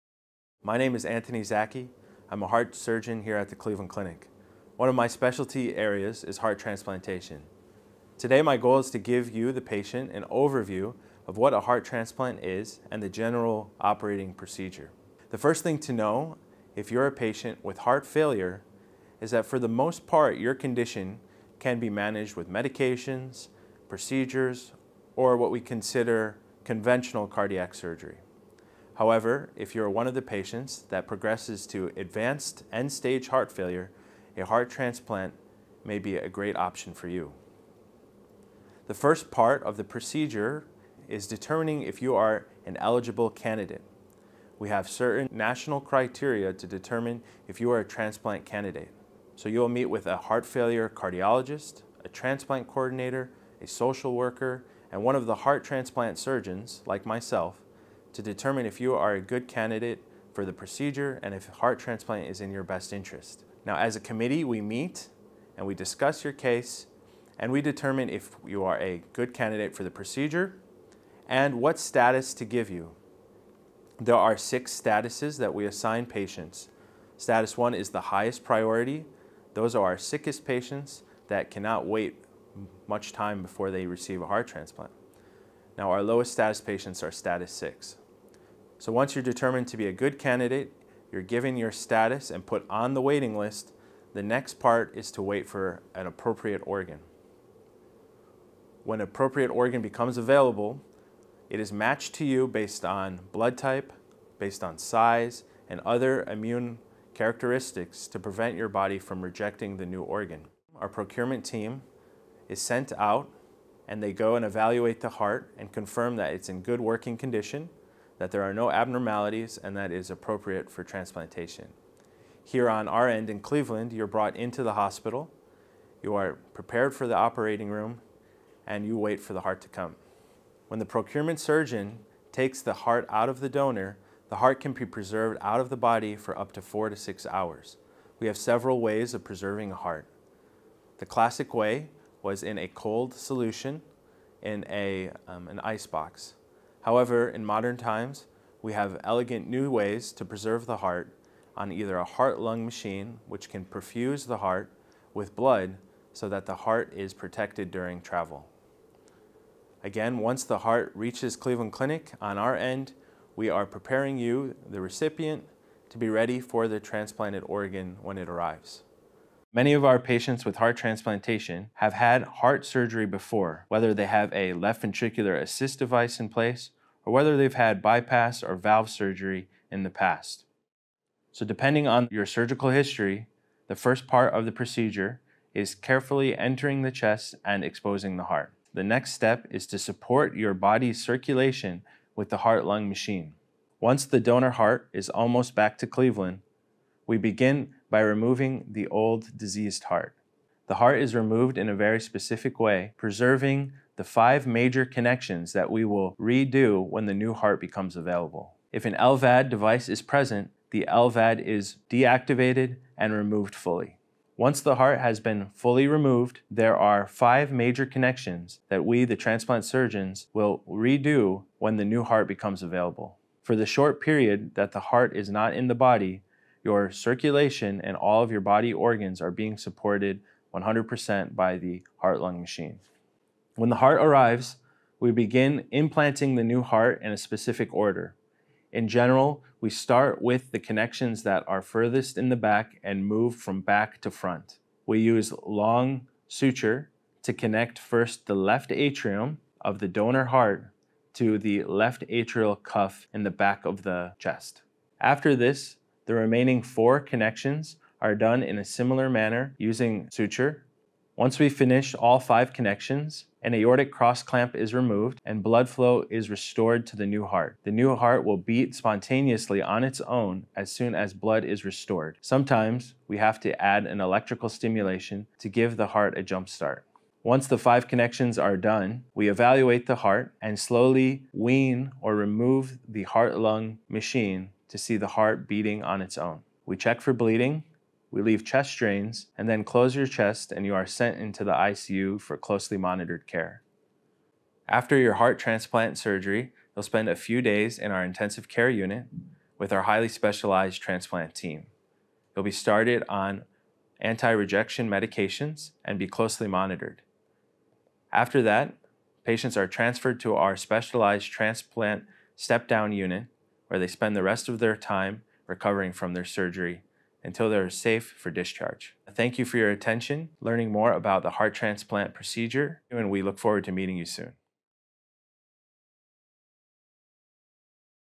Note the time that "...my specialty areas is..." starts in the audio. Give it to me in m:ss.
0:04.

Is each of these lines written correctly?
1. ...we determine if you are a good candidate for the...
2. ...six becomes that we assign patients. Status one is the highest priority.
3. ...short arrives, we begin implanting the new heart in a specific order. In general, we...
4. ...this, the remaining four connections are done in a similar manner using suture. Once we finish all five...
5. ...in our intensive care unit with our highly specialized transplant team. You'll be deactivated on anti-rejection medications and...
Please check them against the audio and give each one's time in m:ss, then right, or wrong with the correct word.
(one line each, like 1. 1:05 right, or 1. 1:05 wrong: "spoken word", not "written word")
1. 1:07 right
2. 1:14 wrong: "statuses", not "becomes"
3. 3:53 wrong: "heart", not "short"
4. 4:15 right
5. 4:57 wrong: "started", not "deactivated".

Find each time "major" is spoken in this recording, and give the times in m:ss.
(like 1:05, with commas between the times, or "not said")
3:24, 3:37.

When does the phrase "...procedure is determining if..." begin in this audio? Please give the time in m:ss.
0:39.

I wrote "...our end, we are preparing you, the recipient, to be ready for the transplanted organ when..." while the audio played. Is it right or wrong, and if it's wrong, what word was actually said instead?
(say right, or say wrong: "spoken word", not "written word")
right.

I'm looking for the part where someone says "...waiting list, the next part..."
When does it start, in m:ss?
1:33.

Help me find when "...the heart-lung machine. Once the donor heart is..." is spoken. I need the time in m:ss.
3:12.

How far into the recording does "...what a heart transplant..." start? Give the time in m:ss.
0:11.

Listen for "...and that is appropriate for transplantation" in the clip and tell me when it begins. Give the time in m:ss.
1:59.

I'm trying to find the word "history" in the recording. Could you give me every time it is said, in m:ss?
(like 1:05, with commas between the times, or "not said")
3:02.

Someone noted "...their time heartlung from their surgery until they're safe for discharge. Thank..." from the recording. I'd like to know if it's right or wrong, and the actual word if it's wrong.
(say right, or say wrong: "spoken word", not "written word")
wrong: "recovering", not "heartlung".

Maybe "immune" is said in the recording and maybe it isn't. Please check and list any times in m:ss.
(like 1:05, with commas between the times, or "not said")
1:46.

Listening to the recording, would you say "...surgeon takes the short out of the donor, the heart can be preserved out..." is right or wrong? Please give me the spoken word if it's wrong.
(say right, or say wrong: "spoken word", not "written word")
wrong: "heart", not "short".